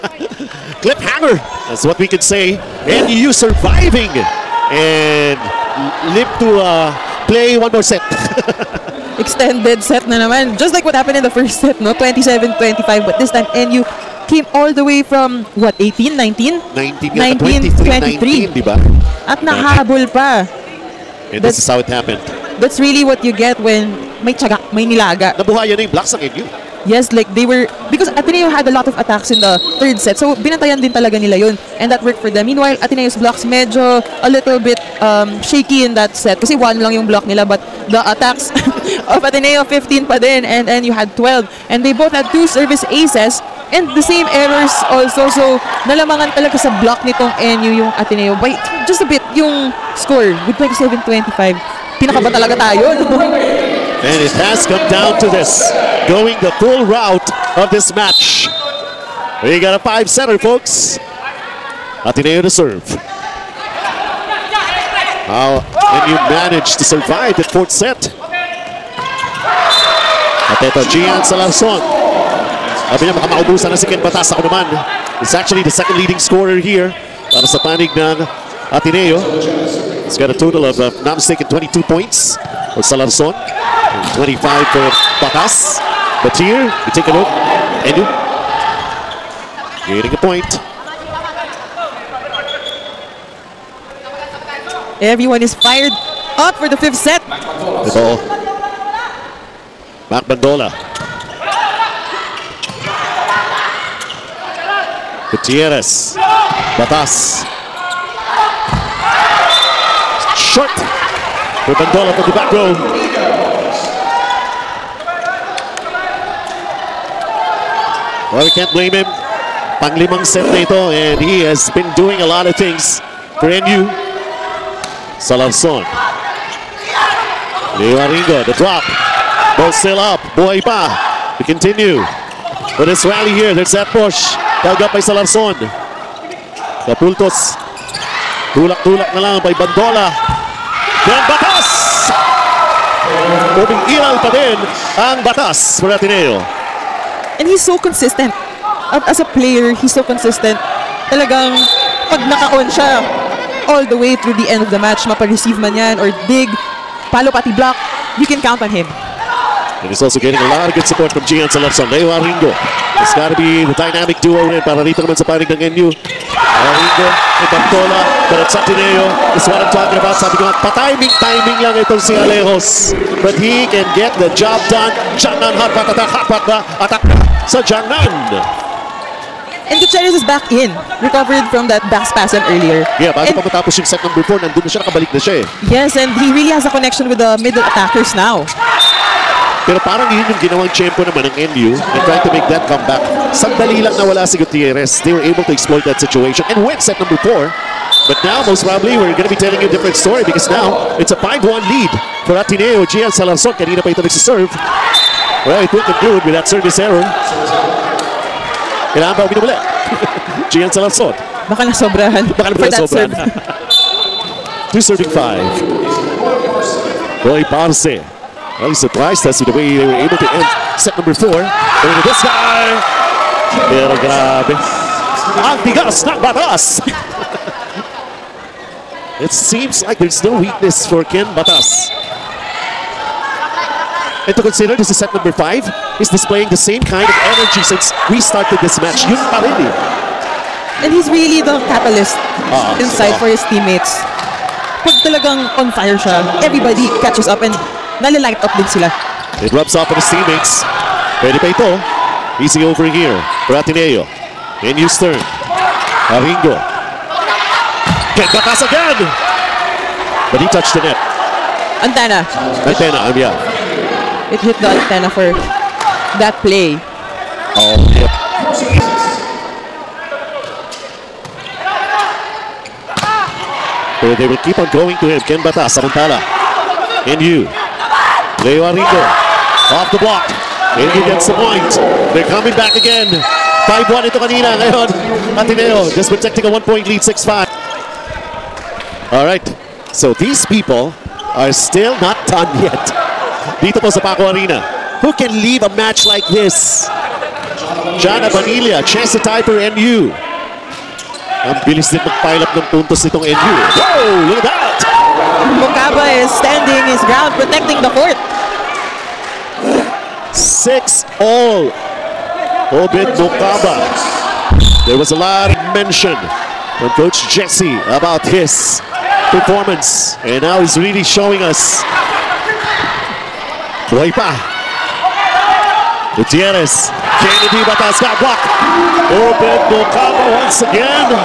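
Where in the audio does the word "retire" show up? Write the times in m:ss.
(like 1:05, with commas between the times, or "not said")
not said.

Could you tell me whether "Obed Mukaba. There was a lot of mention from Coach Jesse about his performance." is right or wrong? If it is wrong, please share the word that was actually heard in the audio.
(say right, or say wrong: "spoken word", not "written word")
right.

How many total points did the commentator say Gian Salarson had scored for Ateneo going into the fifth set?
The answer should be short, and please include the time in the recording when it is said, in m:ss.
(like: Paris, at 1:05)
22, at 1:21.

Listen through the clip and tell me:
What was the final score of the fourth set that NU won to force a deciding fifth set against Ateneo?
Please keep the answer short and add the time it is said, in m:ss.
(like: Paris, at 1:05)
27-25, at 0:50.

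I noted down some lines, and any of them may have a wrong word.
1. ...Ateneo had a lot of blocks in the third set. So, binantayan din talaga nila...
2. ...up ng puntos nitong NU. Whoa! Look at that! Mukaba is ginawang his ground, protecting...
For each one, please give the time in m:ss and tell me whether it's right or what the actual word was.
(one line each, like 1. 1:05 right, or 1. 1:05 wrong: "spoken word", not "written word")
1. 0:28 wrong: "attacks", not "blocks"
2. 5:02 wrong: "standing", not "ginawang".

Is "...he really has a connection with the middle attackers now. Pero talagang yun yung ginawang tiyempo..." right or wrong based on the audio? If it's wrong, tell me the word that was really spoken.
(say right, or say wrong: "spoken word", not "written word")
wrong: "parang", not "talagang".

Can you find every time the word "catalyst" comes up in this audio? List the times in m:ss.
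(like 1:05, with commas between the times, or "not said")
4:01.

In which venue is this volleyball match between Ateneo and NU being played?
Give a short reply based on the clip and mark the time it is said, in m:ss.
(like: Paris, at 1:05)
Paco Arena, at 4:54.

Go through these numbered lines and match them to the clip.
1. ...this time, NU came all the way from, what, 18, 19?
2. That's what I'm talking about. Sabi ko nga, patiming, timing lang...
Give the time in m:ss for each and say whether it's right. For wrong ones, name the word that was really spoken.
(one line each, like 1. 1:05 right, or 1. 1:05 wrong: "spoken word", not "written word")
1. 0:13 right
2. 2:49 right.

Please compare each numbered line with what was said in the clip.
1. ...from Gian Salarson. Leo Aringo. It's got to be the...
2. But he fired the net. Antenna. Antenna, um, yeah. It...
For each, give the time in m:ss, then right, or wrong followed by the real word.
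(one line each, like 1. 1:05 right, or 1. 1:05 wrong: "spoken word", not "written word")
1. 2:41 right
2. 4:20 wrong: "touched", not "fired".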